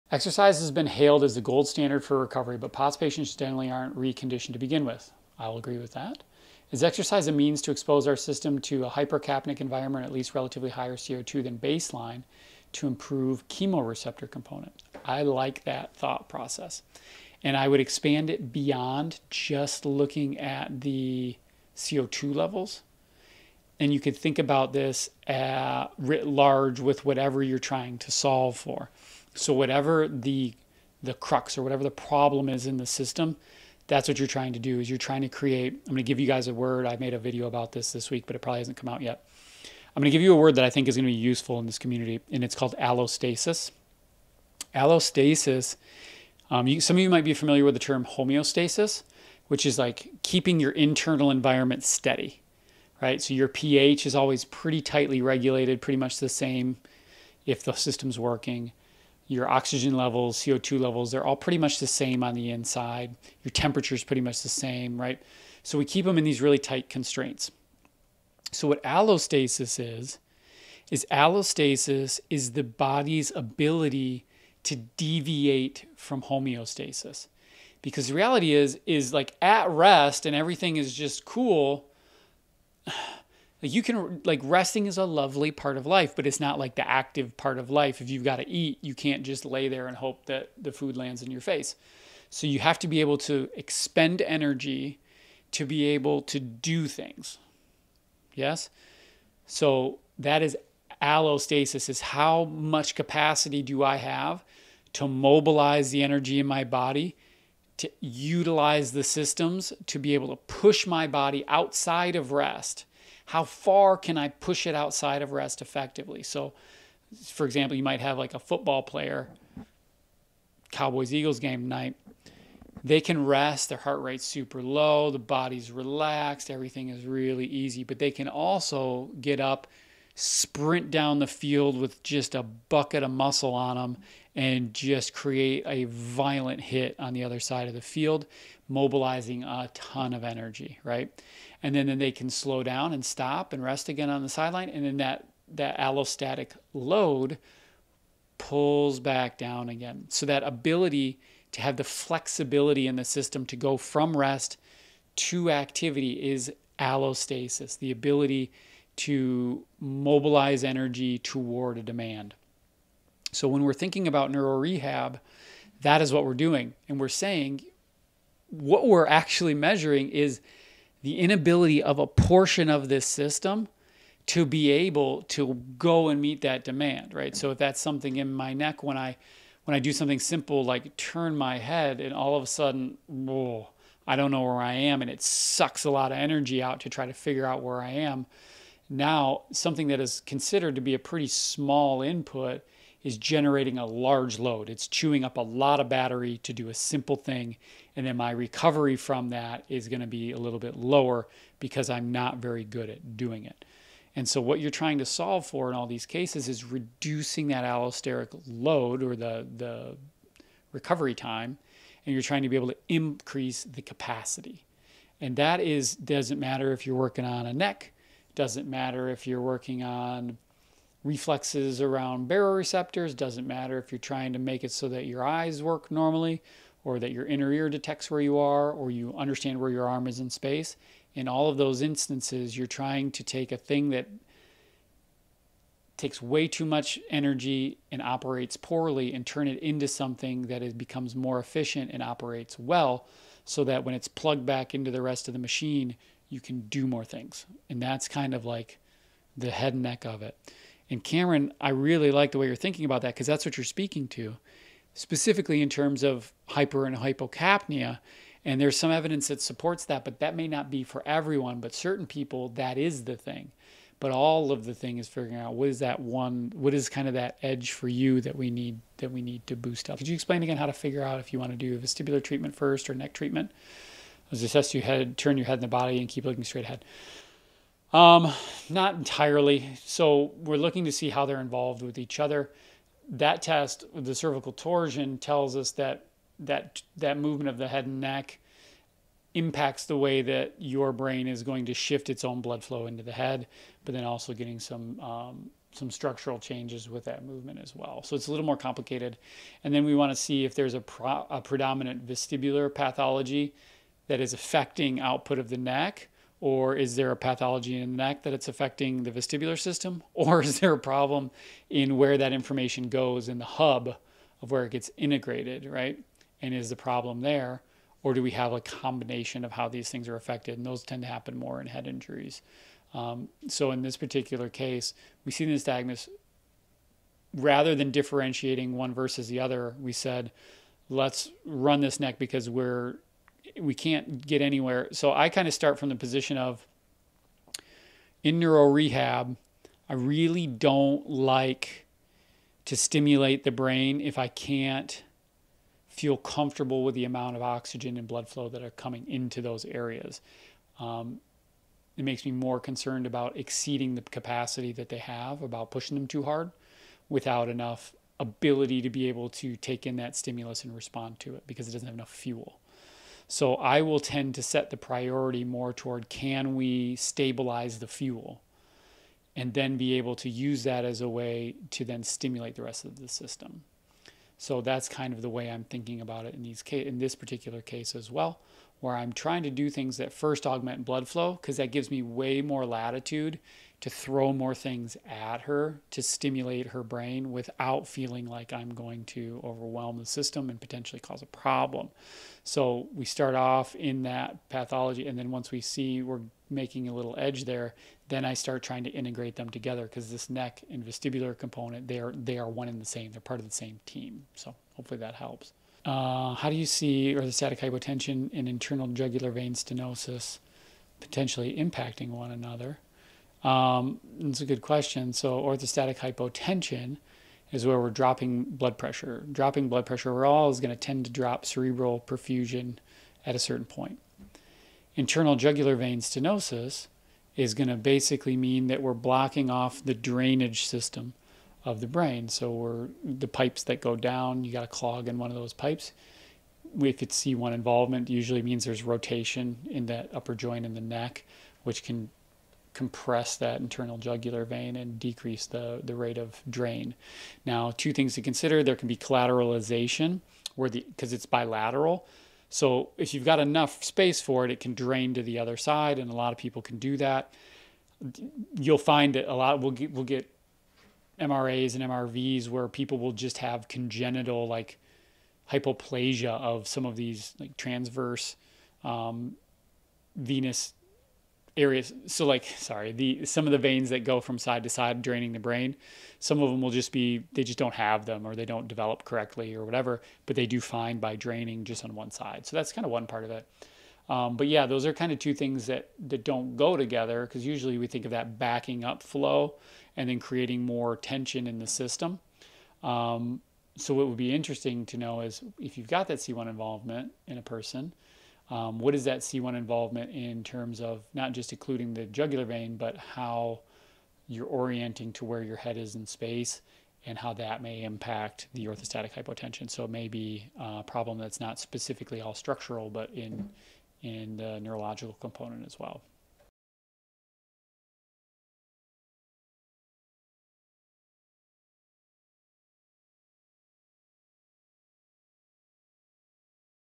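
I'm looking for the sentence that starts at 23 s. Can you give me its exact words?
And you could think about this at, writ large with whatever you're trying to solve for.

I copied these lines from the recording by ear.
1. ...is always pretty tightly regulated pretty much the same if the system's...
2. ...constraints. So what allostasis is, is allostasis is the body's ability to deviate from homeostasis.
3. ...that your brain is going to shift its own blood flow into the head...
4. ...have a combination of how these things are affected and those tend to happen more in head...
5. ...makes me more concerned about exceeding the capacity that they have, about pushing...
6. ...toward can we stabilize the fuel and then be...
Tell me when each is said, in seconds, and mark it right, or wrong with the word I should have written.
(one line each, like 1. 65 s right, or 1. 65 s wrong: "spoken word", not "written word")
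1. 54 s right
2. 66 s right
3. 290 s right
4. 318 s right
5. 352 s right
6. 365 s right.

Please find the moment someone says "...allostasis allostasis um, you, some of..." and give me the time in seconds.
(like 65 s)
42 s.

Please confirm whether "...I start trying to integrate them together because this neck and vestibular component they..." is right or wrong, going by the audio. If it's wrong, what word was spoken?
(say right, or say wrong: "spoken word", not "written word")
right.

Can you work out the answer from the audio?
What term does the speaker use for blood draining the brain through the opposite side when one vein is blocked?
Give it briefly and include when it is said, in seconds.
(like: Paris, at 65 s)
collateralization, at 448 s.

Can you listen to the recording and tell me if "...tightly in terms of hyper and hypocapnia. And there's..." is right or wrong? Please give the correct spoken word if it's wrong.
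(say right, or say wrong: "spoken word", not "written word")
wrong: "specifically", not "tightly".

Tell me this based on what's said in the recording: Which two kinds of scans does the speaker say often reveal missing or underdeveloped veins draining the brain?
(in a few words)
MRAs and MRVs.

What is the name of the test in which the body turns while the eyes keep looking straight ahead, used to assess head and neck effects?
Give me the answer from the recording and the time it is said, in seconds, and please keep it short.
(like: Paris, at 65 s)
cervical torsion, at 284 s.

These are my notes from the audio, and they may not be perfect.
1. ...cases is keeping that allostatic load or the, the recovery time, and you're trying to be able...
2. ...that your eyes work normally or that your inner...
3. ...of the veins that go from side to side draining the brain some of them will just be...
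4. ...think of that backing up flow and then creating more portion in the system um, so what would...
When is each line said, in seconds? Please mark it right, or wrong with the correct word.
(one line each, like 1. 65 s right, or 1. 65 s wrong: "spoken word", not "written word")
1. 206 s wrong: "reducing", not "keeping"
2. 224 s right
3. 473 s right
4. 487 s wrong: "tension", not "portion".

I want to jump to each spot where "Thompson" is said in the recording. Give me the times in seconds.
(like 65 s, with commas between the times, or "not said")
not said.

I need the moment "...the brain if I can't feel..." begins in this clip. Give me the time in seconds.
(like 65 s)
343 s.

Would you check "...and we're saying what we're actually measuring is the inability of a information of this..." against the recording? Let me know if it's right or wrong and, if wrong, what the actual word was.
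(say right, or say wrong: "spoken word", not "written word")
wrong: "portion", not "information".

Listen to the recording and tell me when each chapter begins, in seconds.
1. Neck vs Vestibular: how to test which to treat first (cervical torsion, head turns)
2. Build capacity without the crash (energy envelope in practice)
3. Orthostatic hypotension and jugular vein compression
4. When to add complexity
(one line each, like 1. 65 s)
1. 270 s
2. 205 s
3. 450 s
4. 400 s.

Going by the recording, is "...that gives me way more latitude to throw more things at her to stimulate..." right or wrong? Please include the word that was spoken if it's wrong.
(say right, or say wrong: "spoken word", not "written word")
right.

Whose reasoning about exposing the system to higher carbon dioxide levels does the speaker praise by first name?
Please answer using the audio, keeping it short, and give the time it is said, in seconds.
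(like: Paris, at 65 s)
Cameron, at 251 s.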